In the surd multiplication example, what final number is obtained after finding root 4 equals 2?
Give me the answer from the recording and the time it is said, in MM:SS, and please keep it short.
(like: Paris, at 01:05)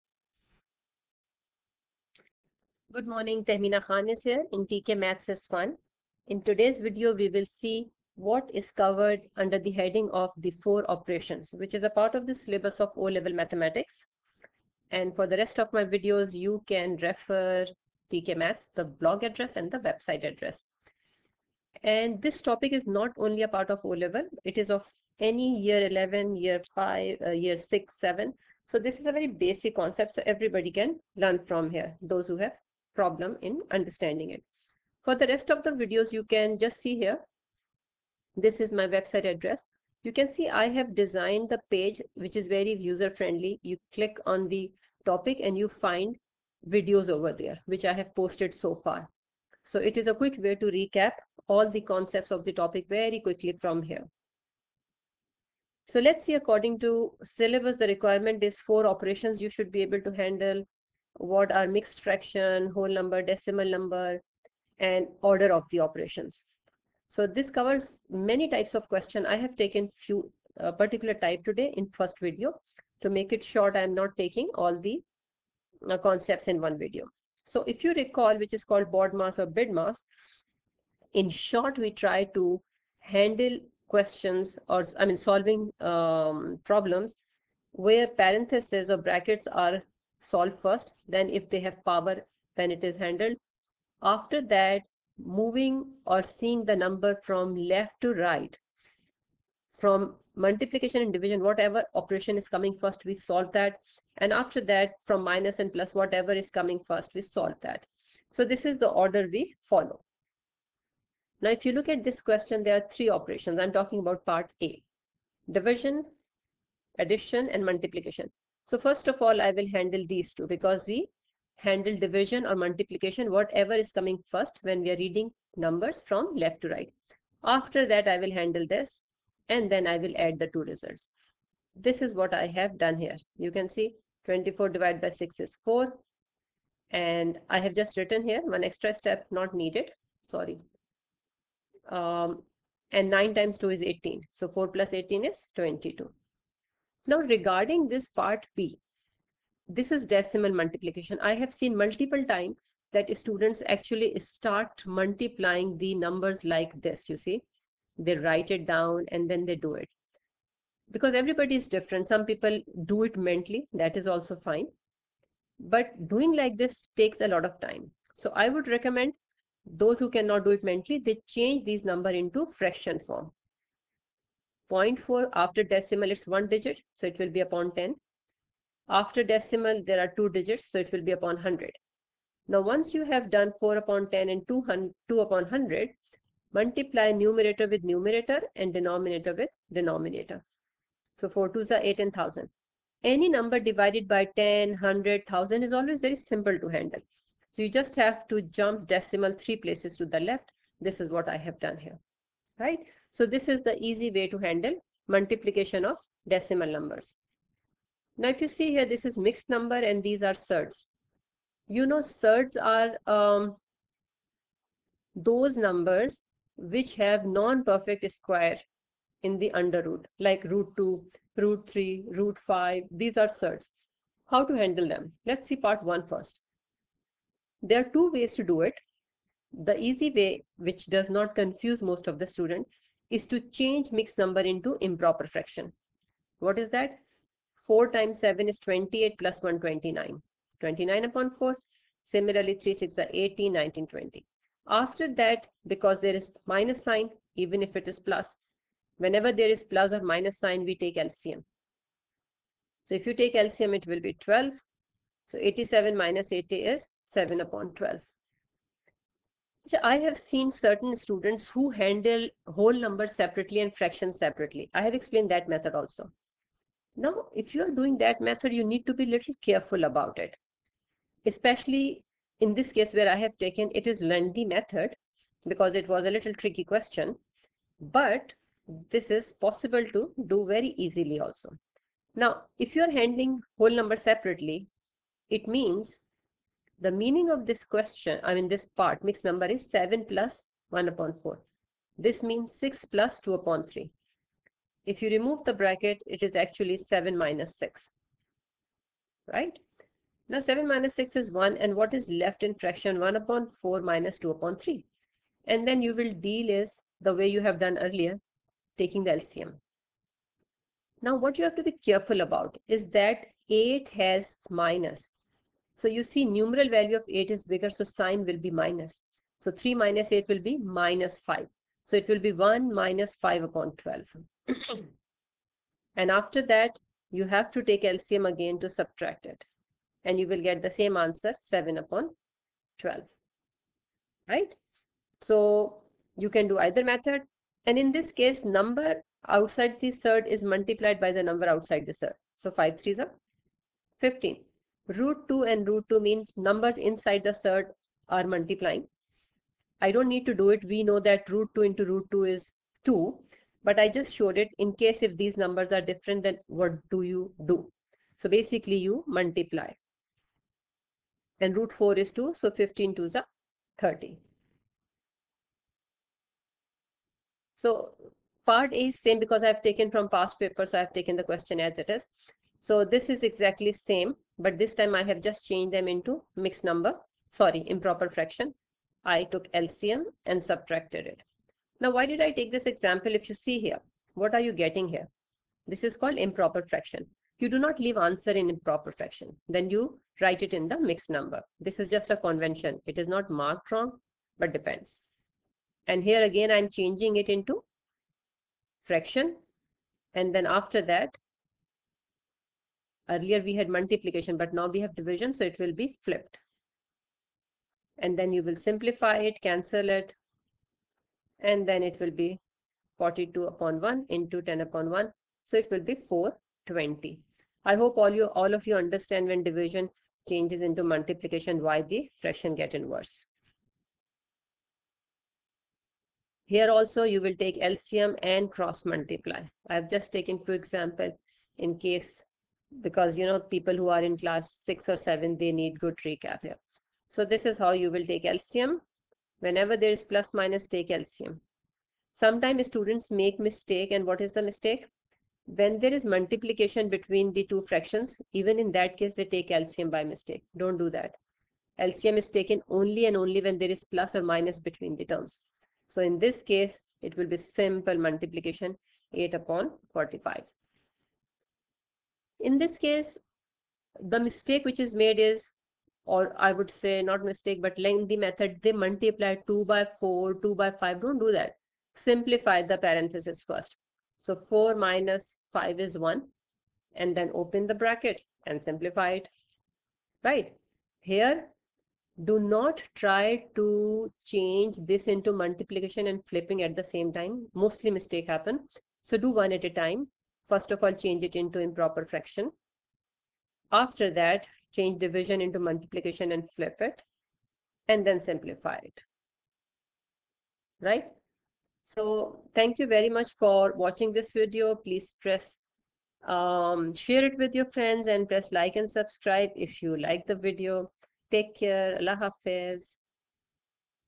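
30, at 06:03.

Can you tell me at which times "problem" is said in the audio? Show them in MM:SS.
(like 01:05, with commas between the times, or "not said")
00:32, 01:26.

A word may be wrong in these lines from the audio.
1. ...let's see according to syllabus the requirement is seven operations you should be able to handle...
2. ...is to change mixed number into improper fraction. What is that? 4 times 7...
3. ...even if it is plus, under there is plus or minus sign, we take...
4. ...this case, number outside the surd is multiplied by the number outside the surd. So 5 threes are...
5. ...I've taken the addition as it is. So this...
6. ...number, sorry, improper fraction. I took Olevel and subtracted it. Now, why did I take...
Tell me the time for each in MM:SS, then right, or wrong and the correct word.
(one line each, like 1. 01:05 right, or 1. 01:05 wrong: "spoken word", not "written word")
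1. 00:55 wrong: "four", not "seven"
2. 03:53 right
3. 04:07 wrong: "whenever", not "under"
4. 05:37 right
5. 06:10 wrong: "question", not "addition"
6. 06:16 wrong: "LCM", not "Olevel".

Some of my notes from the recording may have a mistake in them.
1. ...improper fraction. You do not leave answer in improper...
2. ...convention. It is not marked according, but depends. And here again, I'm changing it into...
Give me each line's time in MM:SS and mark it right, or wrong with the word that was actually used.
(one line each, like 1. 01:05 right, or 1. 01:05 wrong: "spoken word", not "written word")
1. 06:26 right
2. 06:32 wrong: "wrong", not "according".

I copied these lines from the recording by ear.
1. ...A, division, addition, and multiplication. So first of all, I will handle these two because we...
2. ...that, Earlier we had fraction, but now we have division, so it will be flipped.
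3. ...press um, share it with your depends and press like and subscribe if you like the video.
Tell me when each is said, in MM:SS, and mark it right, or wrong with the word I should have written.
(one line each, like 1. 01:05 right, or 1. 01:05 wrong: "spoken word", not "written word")
1. 01:54 right
2. 06:40 wrong: "multiplication", not "fraction"
3. 08:25 wrong: "friends", not "depends".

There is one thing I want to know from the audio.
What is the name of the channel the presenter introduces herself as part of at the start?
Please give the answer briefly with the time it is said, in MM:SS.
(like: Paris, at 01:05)
TK Maths S1, at 00:04.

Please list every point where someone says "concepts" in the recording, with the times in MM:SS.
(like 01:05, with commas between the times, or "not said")
00:29, 00:51, 01:15.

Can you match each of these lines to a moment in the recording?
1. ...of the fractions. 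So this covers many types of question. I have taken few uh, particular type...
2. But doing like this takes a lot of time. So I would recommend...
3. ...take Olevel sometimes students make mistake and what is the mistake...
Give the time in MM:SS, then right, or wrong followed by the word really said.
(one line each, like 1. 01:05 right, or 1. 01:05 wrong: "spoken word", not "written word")
1. 01:05 wrong: "operations", not "fractions"
2. 02:45 right
3. 07:20 wrong: "LCM", not "Olevel".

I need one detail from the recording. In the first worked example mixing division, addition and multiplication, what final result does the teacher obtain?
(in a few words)
22.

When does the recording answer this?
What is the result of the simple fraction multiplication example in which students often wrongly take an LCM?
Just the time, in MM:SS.
07:39.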